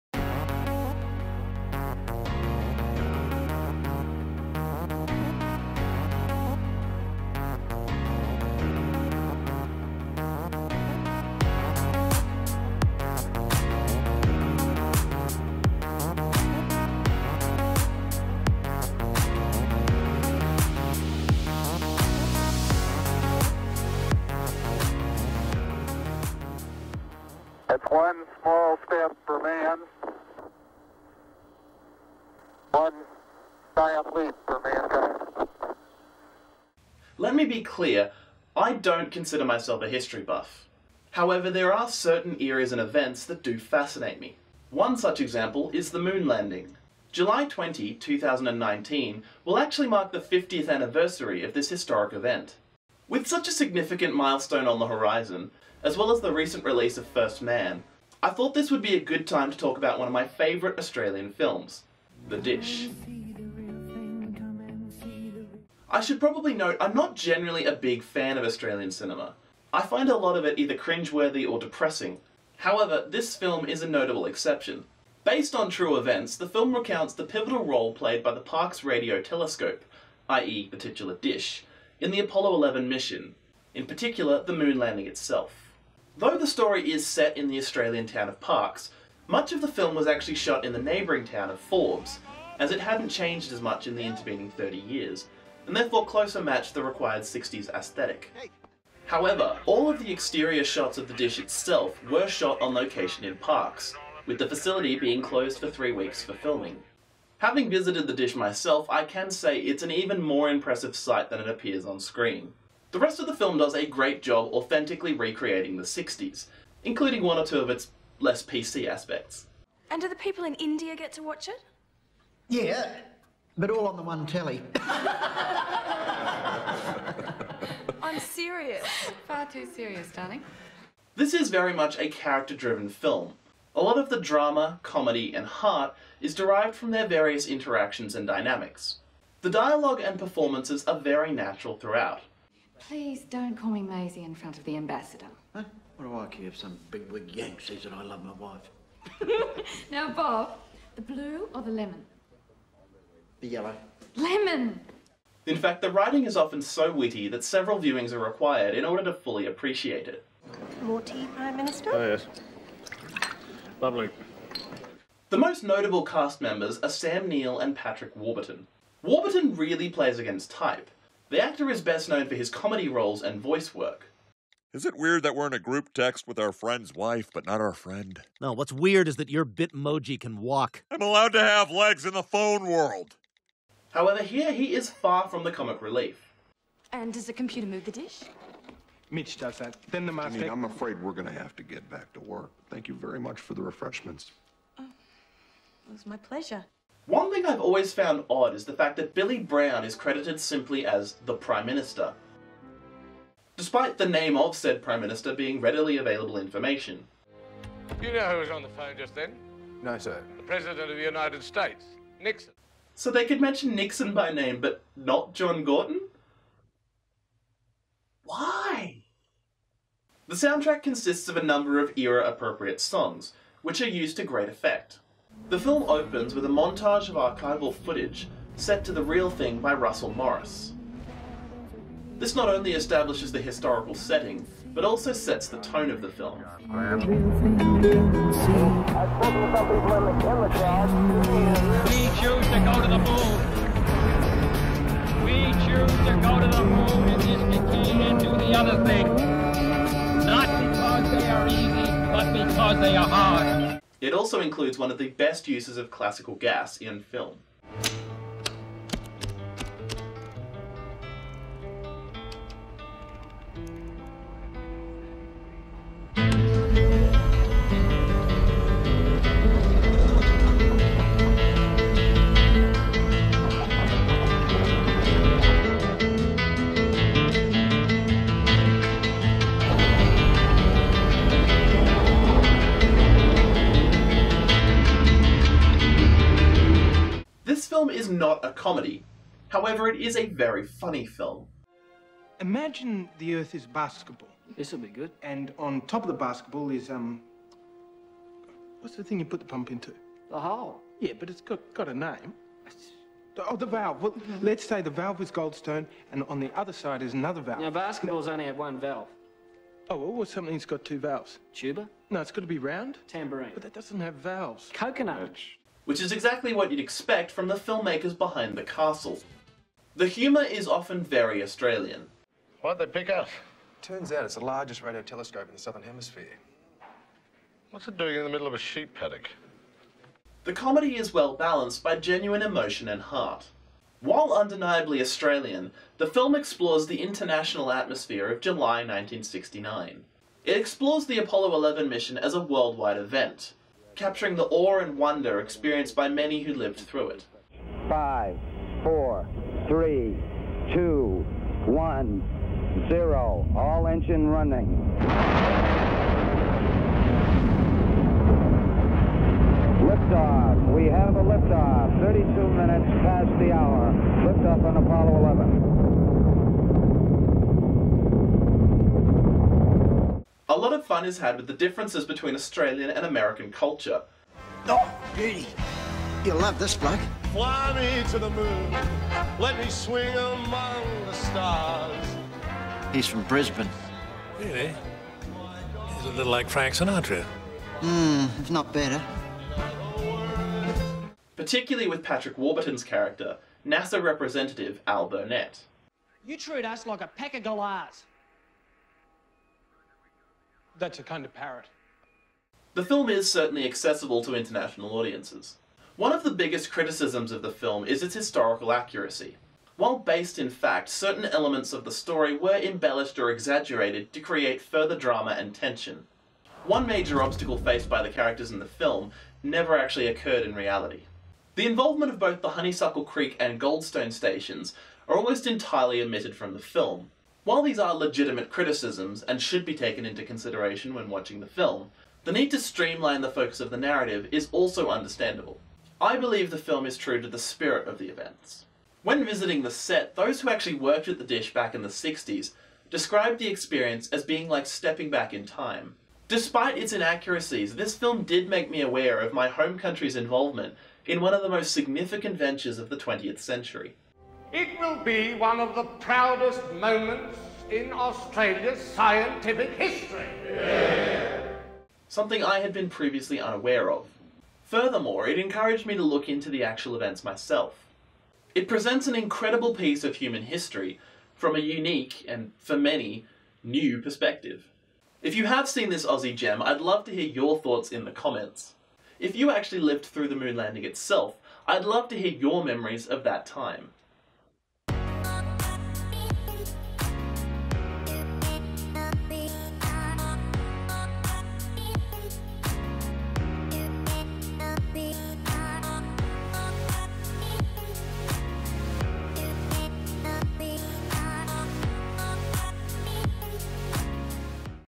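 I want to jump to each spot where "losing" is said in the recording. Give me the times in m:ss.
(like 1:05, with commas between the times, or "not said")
not said.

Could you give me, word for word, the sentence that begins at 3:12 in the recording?
Thank you very much for the refreshments.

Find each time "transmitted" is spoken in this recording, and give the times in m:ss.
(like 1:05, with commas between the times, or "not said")
not said.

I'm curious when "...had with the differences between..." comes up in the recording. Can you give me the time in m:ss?
6:11.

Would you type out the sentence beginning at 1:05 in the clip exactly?
I should probably note I'm not generally a big fan of Australian cinema.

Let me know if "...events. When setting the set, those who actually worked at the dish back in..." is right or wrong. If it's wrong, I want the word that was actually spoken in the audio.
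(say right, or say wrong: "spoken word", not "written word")
wrong: "visiting", not "setting".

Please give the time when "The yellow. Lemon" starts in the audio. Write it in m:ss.
2:33.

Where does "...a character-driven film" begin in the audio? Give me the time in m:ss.
2:11.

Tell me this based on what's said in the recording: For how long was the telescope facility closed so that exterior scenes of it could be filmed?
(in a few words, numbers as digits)
three weeks.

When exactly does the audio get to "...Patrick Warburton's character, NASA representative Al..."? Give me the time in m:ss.
6:32.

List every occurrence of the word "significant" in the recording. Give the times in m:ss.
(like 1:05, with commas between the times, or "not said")
0:53, 7:31.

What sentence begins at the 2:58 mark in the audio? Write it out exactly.
No, what's weird is that your Bitmoji can walk.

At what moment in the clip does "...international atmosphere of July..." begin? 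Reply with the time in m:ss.
5:37.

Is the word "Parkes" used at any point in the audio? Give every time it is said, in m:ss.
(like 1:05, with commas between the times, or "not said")
1:18, 1:28, 1:43.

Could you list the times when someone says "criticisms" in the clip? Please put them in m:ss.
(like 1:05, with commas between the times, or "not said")
6:46, 7:08.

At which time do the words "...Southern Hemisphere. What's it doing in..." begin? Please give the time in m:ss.
5:25.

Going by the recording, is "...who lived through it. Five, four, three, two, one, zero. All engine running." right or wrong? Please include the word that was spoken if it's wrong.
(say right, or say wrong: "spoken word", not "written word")
right.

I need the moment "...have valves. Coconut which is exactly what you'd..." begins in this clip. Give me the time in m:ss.
5:13.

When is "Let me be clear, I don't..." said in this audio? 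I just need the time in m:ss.
0:37.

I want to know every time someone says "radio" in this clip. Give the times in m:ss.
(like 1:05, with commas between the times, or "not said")
1:18, 5:24.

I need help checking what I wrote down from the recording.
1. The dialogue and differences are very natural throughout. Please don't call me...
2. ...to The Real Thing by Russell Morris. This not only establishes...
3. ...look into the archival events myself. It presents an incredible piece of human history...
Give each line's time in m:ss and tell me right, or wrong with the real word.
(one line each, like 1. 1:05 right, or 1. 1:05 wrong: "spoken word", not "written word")
1. 2:19 wrong: "performances", not "differences"
2. 3:48 right
3. 7:46 wrong: "actual", not "archival".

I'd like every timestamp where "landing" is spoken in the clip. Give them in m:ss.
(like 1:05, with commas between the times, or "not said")
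0:46, 1:24, 8:00.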